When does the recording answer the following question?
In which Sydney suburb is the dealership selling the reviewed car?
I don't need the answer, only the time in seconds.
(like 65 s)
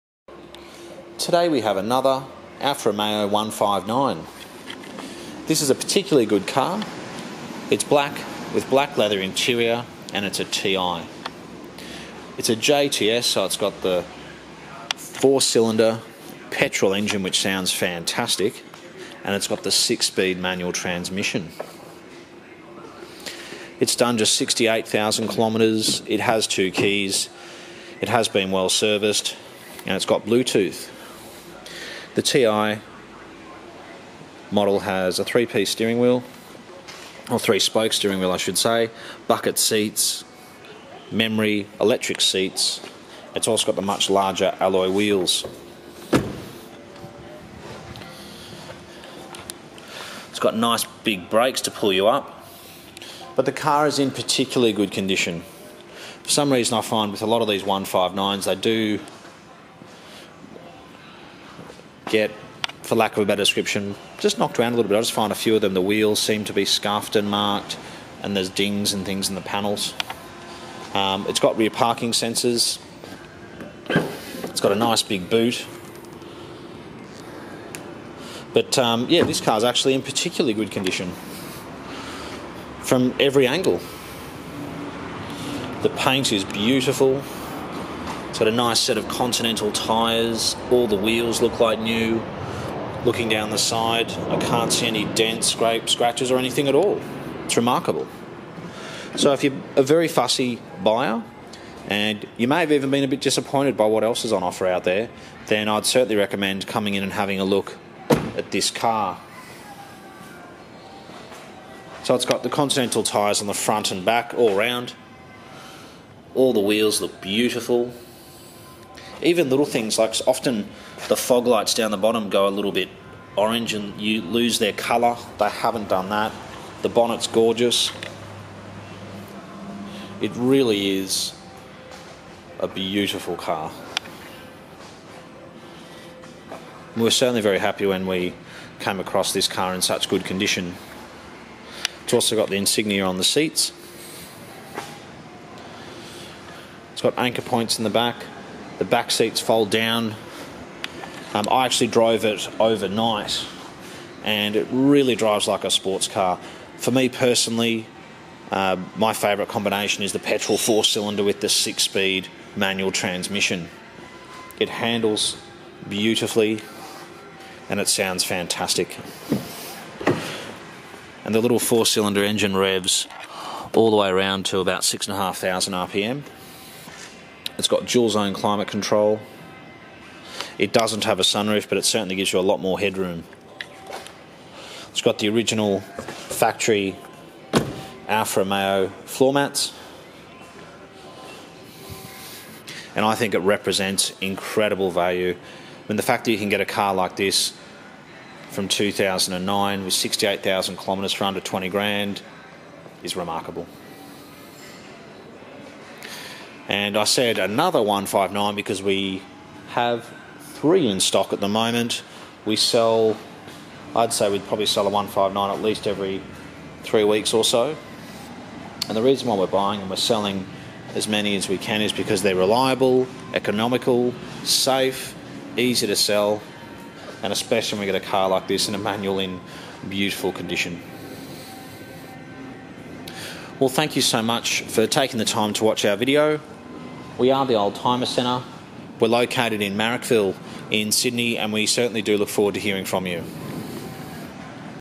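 239 s.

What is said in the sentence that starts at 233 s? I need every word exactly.
Well, thank you so much for taking the time to watch our video.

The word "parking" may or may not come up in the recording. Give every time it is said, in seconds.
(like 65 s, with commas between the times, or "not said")
71 s.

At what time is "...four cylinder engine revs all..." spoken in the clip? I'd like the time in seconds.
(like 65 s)
171 s.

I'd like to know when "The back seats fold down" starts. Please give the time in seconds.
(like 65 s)
148 s.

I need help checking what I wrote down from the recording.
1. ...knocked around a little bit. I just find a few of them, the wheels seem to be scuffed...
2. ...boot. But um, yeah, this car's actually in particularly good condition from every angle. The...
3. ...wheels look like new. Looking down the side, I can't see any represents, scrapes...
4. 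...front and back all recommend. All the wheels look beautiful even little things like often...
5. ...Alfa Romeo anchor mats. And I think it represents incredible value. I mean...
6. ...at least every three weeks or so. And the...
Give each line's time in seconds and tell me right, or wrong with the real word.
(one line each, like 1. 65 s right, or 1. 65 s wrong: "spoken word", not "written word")
1. 64 s right
2. 75 s right
3. 90 s wrong: "dents", not "represents"
4. 113 s wrong: "round", not "recommend"
5. 188 s wrong: "floor", not "anchor"
6. 215 s right.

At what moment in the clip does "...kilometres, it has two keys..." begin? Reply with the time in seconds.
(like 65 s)
25 s.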